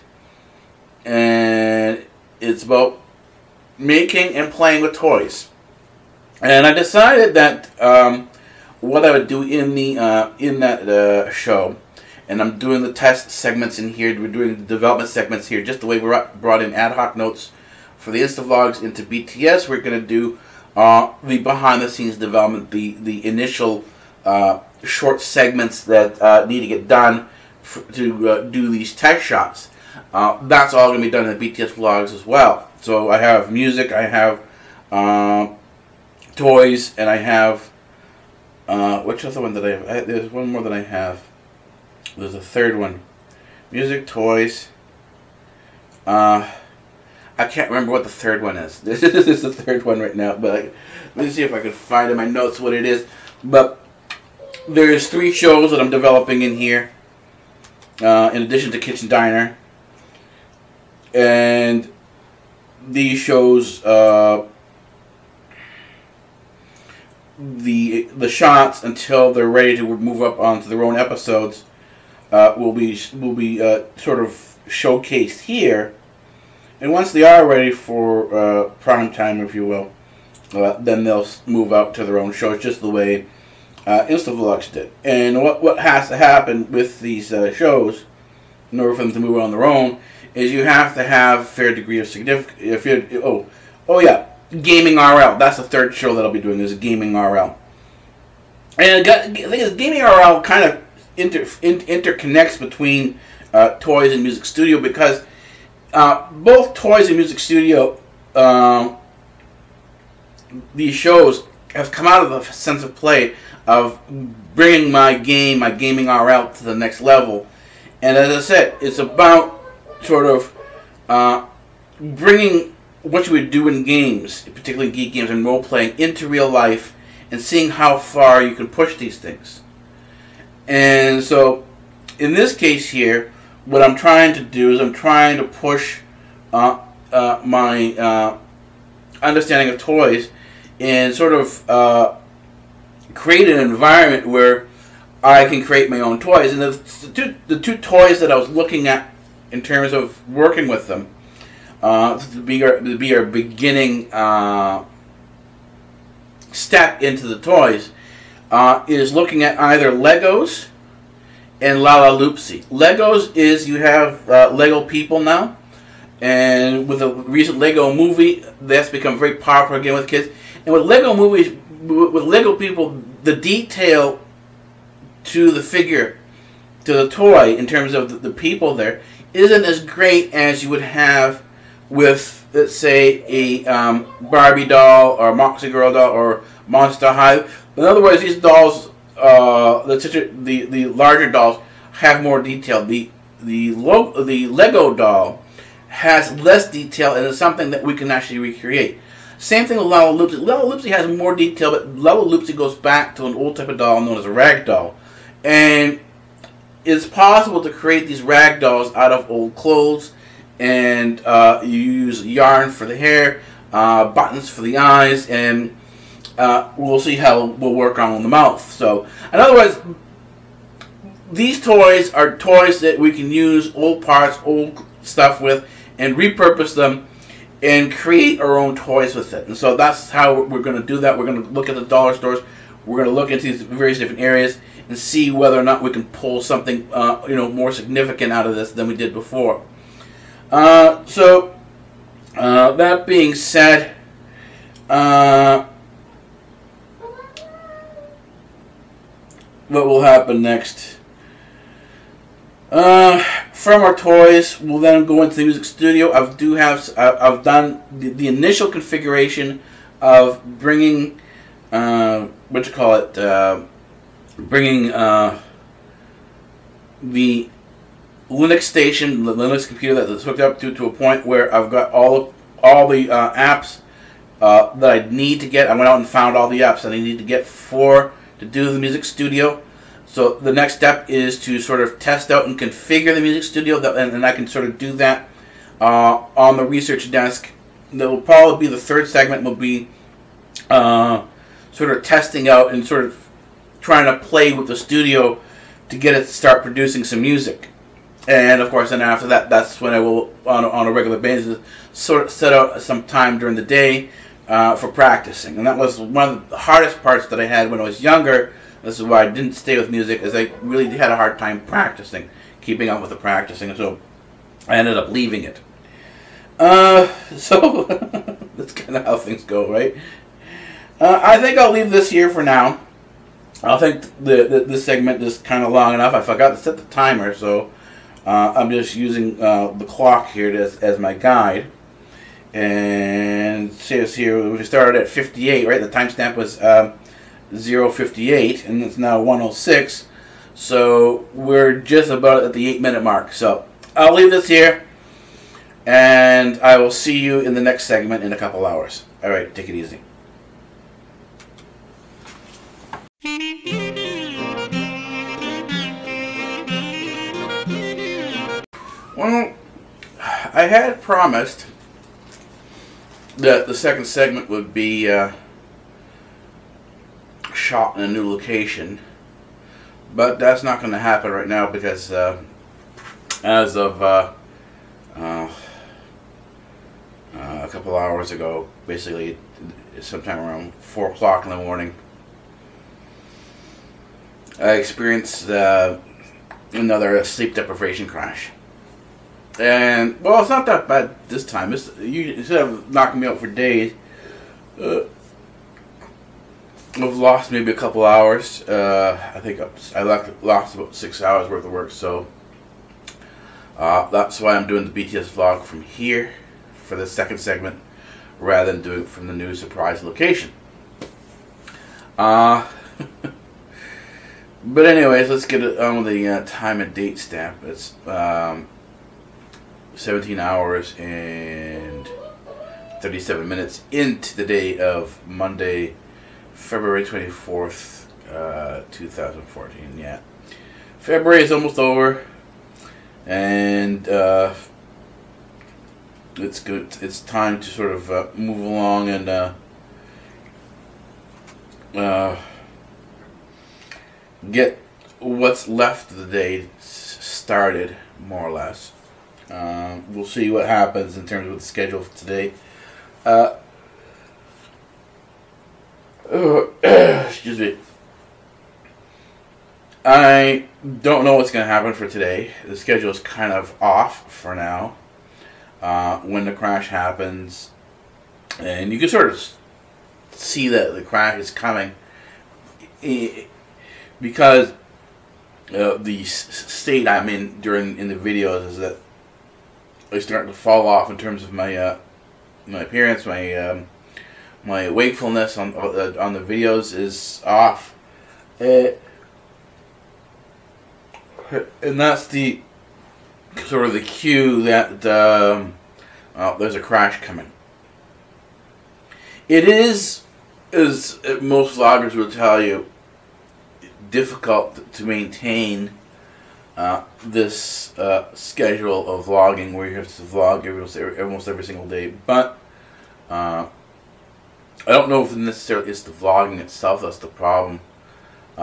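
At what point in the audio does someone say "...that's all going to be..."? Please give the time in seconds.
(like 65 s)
30 s.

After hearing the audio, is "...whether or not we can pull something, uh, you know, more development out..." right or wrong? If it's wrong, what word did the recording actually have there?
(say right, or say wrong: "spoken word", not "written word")
wrong: "significant", not "development".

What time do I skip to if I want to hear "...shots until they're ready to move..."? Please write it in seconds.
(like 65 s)
68 s.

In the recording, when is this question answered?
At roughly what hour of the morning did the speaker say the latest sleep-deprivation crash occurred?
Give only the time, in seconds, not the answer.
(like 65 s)
380 s.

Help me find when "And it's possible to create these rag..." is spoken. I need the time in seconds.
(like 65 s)
205 s.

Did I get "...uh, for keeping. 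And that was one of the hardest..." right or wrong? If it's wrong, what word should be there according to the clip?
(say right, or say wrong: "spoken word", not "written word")
wrong: "practicing", not "keeping".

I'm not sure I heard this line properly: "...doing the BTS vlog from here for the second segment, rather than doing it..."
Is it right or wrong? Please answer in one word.
right.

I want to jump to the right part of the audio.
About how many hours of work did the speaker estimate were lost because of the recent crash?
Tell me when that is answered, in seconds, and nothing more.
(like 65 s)
400 s.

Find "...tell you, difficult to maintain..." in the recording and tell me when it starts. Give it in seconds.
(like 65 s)
502 s.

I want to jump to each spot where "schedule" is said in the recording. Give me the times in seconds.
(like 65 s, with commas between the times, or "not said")
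451 s, 462 s, 508 s.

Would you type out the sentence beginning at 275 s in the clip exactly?
I went out and found all the apps that I need to get for to do the music studio.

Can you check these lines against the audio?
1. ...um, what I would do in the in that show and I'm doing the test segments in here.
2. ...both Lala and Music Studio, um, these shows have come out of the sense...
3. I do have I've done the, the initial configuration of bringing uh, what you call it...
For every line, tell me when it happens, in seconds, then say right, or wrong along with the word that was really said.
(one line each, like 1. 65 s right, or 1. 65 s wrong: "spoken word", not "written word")
1. 7 s right
2. 106 s wrong: "Toys", not "Lala"
3. 256 s right.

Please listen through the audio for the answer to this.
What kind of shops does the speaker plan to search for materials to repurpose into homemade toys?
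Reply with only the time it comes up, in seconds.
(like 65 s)
231 s.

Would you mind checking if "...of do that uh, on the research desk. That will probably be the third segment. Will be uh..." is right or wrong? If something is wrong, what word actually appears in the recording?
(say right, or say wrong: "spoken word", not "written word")
right.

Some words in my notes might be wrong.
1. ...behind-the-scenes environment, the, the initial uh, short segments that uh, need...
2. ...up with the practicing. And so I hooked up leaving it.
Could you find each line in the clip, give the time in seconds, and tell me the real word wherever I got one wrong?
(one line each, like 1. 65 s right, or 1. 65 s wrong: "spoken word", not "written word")
1. 21 s wrong: "development", not "environment"
2. 312 s wrong: "ended", not "hooked".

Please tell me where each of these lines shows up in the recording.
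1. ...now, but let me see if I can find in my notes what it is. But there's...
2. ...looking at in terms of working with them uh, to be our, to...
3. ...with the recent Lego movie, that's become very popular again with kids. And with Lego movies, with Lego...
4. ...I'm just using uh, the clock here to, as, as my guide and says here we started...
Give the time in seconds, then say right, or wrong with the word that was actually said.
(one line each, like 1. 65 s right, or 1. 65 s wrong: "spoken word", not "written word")
1. 50 s right
2. 148 s right
3. 166 s right
4. 328 s right.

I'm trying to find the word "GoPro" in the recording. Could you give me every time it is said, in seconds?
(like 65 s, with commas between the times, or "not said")
not said.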